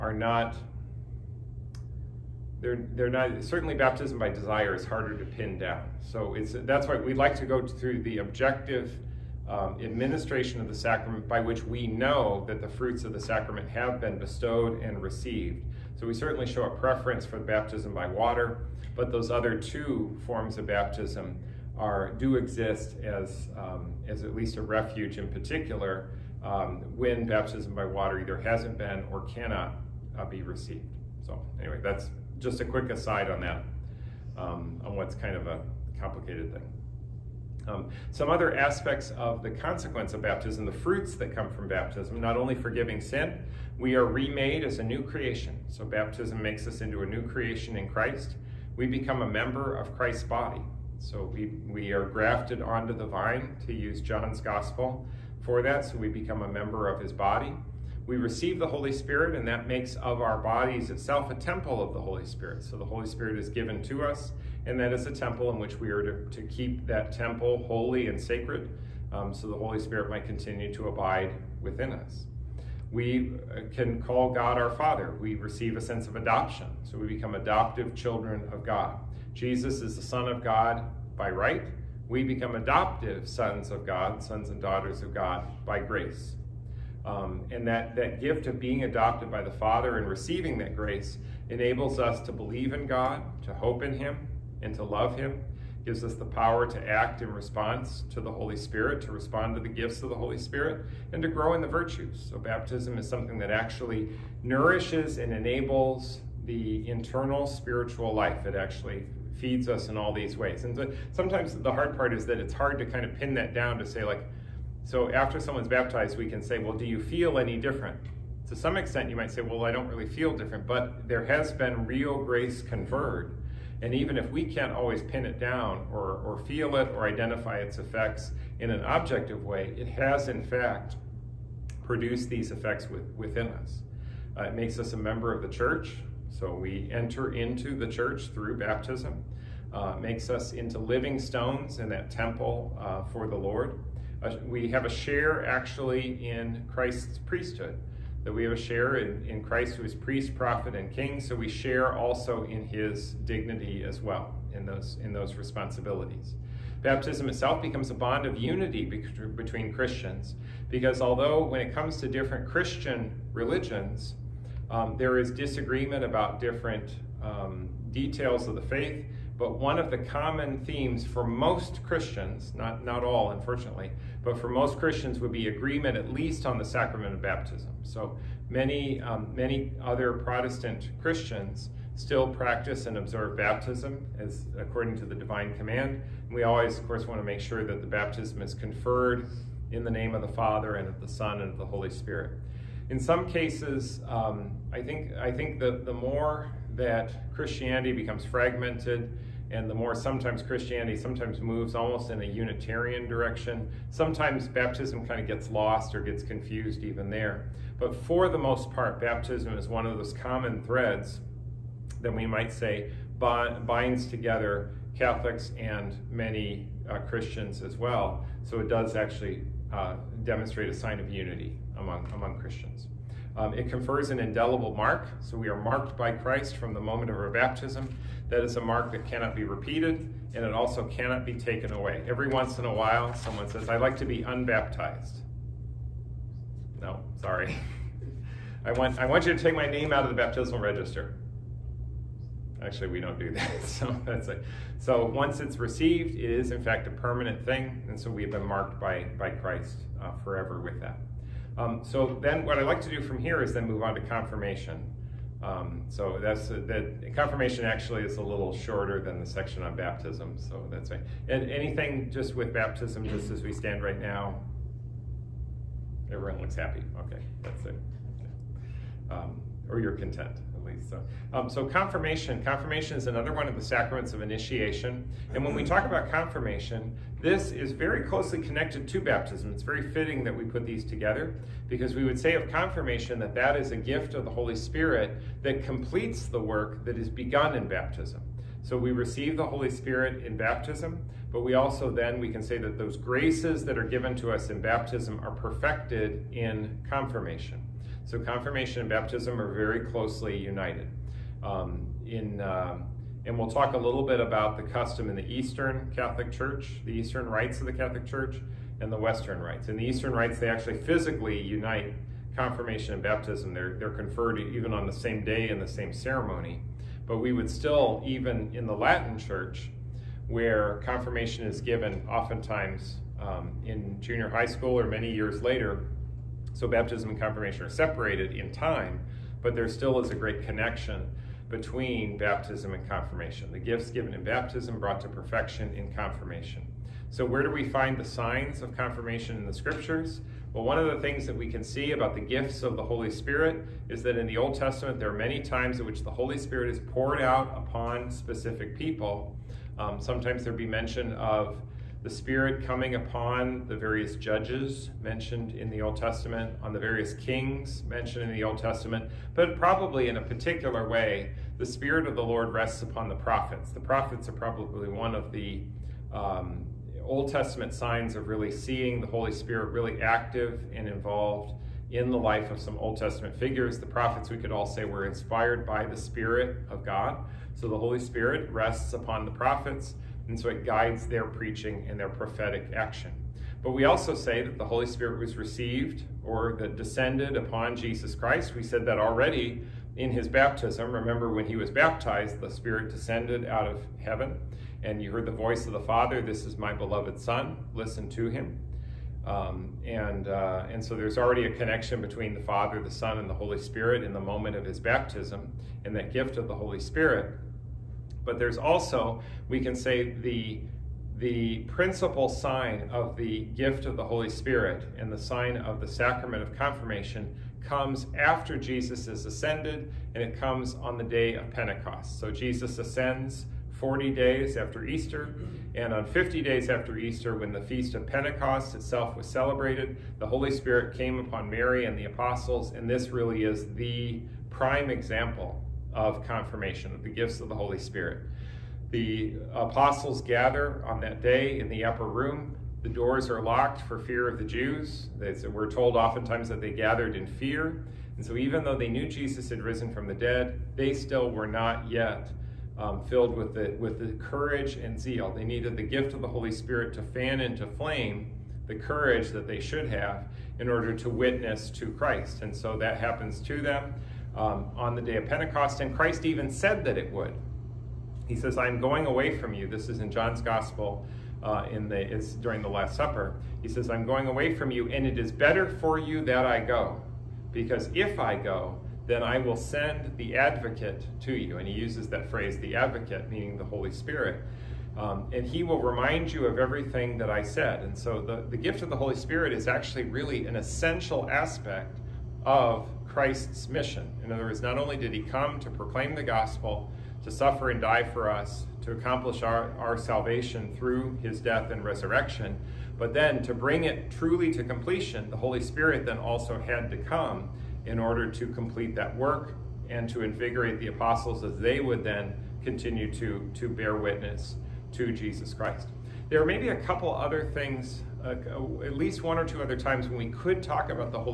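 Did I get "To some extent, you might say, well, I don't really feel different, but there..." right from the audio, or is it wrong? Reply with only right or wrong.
right.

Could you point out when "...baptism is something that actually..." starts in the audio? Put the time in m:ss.
1:42.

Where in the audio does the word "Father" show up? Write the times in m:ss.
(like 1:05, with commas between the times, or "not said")
1:14, 1:29, 3:10, 6:35, 6:42.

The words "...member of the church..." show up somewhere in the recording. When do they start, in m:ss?
2:14.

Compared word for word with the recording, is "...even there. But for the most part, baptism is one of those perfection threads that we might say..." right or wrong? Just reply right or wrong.
wrong.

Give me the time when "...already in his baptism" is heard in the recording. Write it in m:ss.
6:28.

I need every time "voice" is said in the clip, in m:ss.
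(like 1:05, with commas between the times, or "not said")
6:35.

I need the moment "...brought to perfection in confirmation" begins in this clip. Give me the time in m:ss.
5:34.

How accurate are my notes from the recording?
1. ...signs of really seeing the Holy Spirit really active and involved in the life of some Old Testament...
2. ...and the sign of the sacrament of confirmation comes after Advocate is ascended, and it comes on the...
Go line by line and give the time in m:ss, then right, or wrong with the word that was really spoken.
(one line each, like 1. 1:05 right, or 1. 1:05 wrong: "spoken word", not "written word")
1. 6:07 right
2. 6:54 wrong: "Jesus", not "Advocate".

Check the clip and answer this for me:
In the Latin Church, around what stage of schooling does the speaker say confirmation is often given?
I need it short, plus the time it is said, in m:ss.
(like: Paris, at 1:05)
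Junior high school, at 5:23.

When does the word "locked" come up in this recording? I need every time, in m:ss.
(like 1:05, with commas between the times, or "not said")
7:23.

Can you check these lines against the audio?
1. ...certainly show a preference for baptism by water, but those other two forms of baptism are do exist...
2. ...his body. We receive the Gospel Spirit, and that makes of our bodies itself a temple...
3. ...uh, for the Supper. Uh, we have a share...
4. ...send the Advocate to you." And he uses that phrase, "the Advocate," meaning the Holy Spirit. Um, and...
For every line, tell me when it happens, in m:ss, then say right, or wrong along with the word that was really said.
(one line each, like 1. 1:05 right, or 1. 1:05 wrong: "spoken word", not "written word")
1. 0:16 right
2. 0:56 wrong: "Holy", not "Gospel"
3. 2:22 wrong: "Lord", not "Supper"
4. 7:59 right.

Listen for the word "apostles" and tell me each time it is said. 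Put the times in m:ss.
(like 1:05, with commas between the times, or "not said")
7:12, 7:19, 8:30.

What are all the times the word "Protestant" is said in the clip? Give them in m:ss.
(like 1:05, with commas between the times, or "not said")
3:00.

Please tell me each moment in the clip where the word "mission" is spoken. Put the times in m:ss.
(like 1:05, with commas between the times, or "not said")
8:13.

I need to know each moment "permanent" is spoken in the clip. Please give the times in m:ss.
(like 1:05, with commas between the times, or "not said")
4:06.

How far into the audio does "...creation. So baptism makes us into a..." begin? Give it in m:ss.
0:45.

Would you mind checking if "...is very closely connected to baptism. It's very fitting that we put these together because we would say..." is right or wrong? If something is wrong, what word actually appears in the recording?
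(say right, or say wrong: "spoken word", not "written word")
right.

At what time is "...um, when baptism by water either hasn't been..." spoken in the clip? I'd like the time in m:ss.
0:26.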